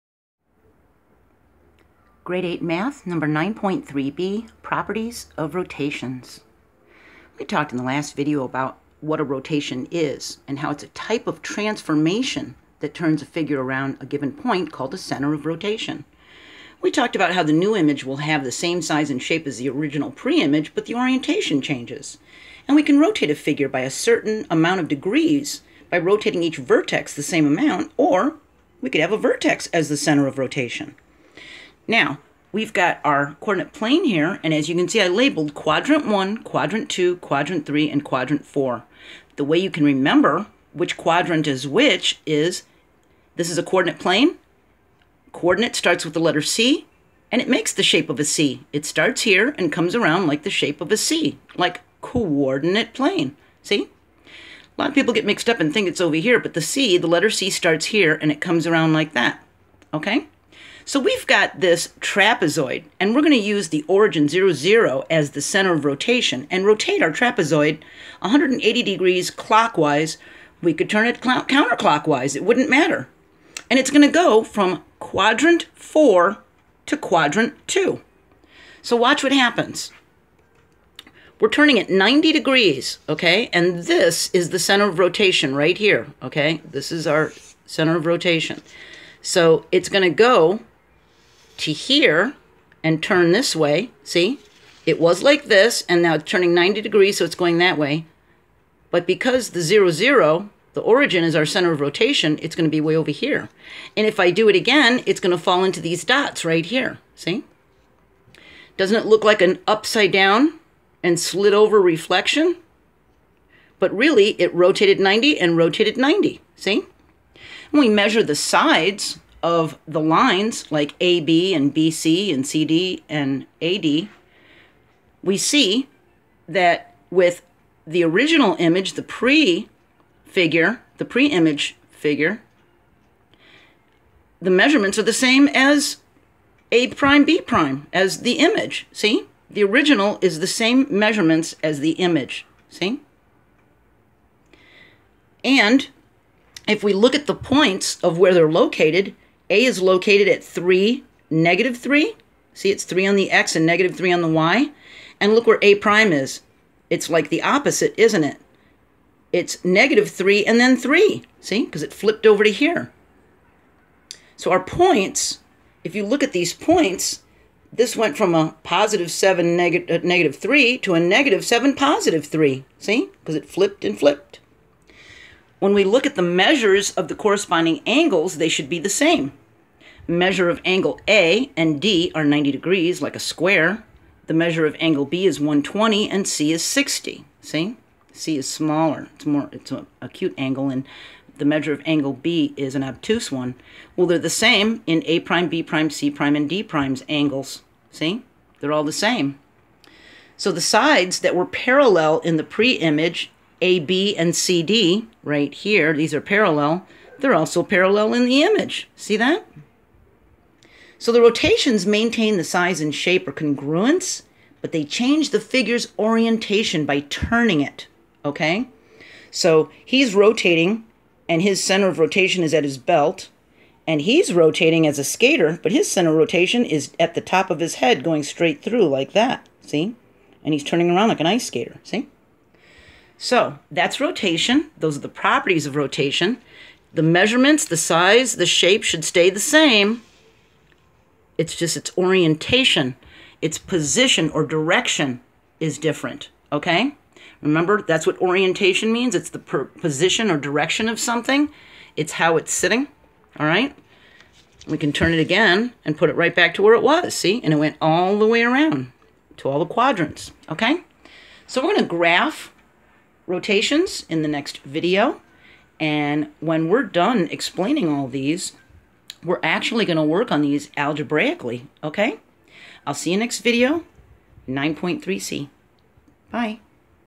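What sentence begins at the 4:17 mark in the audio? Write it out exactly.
And it went all the way around to all the quadrants, okay?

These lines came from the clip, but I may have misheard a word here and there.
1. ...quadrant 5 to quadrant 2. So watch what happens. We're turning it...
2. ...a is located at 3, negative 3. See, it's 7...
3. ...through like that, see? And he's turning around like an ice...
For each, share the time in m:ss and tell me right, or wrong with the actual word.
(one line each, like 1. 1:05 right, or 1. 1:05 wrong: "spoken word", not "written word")
1. 1:14 wrong: "4", not "5"
2. 2:29 wrong: "3", not "7"
3. 3:48 right.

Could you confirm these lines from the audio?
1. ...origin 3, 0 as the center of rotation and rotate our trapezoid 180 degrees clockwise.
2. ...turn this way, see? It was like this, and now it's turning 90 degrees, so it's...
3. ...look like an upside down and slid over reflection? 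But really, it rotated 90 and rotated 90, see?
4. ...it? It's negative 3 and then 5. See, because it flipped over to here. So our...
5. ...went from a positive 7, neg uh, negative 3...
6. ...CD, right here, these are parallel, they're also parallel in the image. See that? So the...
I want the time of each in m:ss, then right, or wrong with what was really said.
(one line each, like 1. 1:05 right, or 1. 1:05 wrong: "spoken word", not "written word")
1. 1:03 wrong: "0", not "3"
2. 1:33 right
3. 1:49 right
4. 2:38 wrong: "3", not "5"
5. 2:47 right
6. 3:24 right.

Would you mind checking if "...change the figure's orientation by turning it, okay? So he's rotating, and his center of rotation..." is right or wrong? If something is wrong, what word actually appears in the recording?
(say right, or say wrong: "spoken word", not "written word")
right.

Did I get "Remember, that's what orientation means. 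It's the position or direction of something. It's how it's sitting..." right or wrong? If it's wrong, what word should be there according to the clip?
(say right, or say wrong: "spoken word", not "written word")
right.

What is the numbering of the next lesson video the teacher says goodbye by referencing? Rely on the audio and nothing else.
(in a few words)
9.3c.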